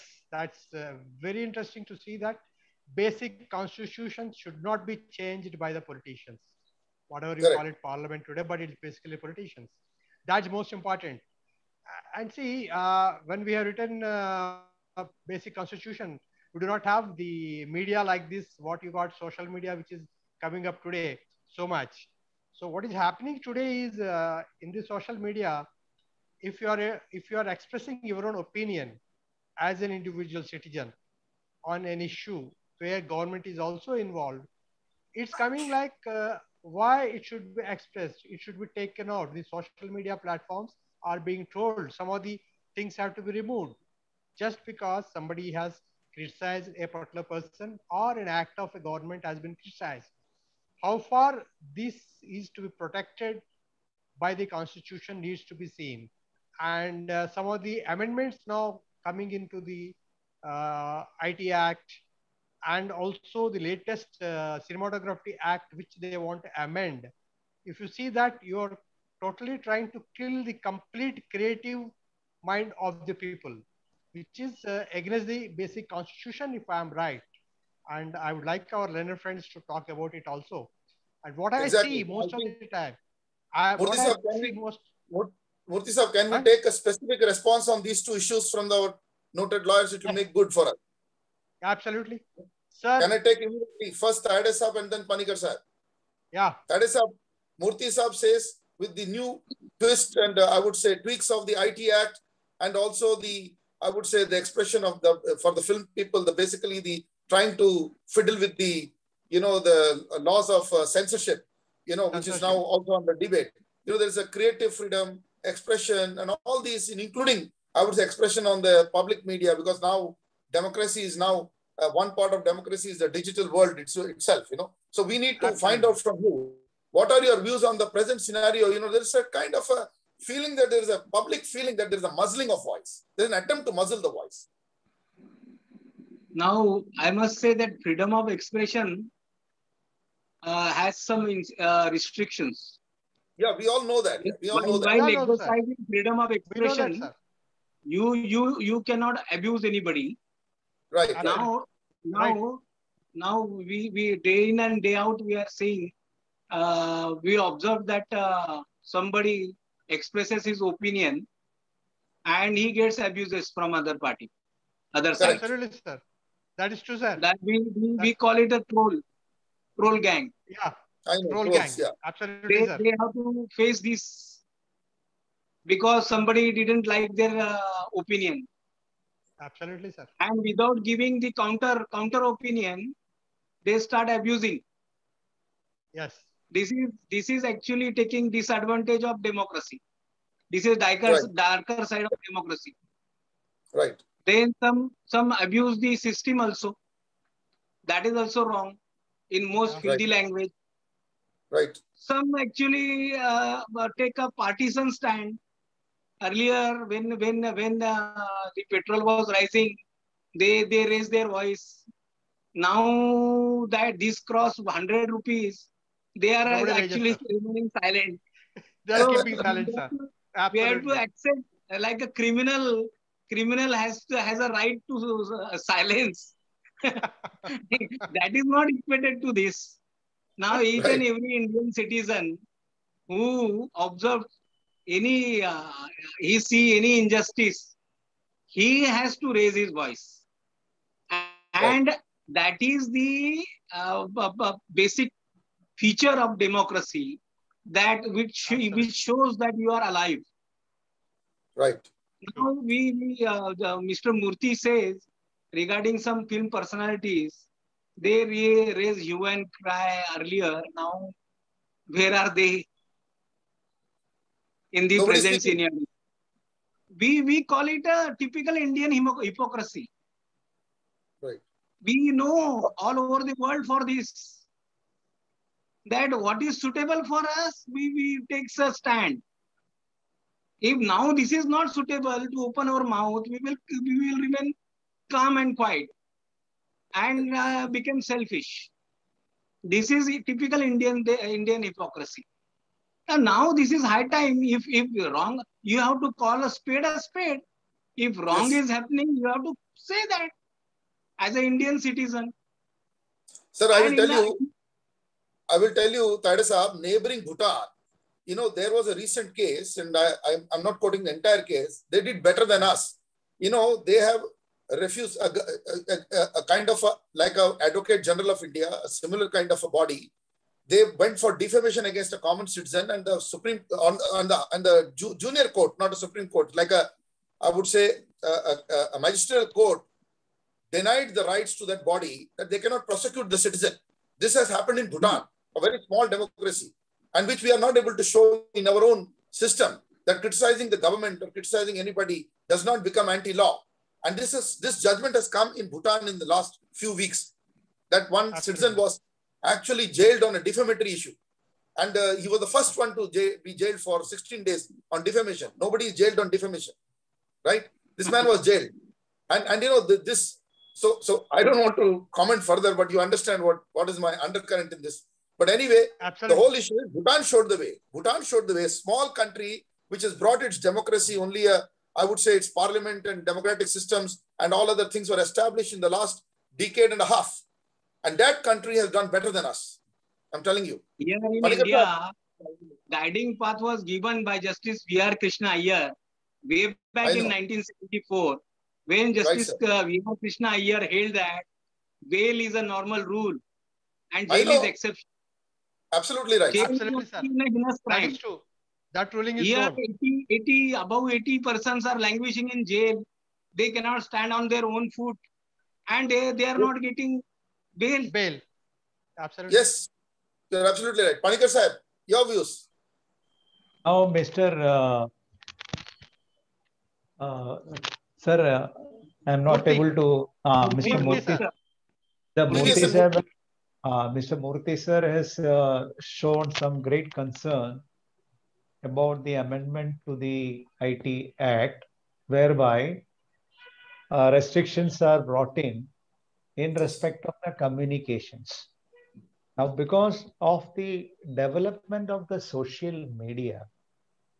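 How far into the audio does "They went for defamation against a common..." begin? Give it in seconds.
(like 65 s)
320 s.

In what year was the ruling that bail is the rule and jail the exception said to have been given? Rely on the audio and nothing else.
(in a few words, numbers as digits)
1974.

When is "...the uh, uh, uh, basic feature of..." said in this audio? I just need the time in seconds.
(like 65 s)
242 s.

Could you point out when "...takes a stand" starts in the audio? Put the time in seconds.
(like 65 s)
278 s.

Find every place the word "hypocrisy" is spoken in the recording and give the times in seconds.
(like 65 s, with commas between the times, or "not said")
269 s, 291 s.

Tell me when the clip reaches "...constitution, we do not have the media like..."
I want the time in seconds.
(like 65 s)
15 s.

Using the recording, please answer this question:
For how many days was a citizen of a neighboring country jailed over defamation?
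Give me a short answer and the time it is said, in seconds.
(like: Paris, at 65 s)
16, at 354 s.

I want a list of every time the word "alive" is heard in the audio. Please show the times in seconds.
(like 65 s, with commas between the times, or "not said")
249 s.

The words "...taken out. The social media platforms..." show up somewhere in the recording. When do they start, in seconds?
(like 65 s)
38 s.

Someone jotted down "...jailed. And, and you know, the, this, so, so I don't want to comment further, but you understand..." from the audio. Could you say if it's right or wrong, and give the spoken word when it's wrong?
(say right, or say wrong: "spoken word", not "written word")
right.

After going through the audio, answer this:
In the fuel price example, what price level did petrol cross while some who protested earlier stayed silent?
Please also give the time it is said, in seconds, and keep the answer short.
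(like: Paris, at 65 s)
100 rupees, at 214 s.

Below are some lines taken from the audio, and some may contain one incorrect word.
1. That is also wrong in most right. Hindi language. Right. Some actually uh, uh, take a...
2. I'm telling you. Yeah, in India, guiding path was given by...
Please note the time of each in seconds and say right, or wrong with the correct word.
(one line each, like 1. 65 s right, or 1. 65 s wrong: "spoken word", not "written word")
1. 197 s right
2. 380 s right.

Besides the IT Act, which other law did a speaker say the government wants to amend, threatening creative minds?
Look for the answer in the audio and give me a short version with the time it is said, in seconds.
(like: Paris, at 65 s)
Cinematography Act, at 64 s.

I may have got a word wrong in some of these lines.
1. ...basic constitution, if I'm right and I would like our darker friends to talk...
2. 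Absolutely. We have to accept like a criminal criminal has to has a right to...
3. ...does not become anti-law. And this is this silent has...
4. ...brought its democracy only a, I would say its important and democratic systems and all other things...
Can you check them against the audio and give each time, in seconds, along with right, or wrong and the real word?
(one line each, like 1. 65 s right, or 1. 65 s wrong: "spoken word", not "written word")
1. 75 s wrong: "learner", not "darker"
2. 220 s right
3. 342 s wrong: "judgment", not "silent"
4. 370 s wrong: "parliament", not "important".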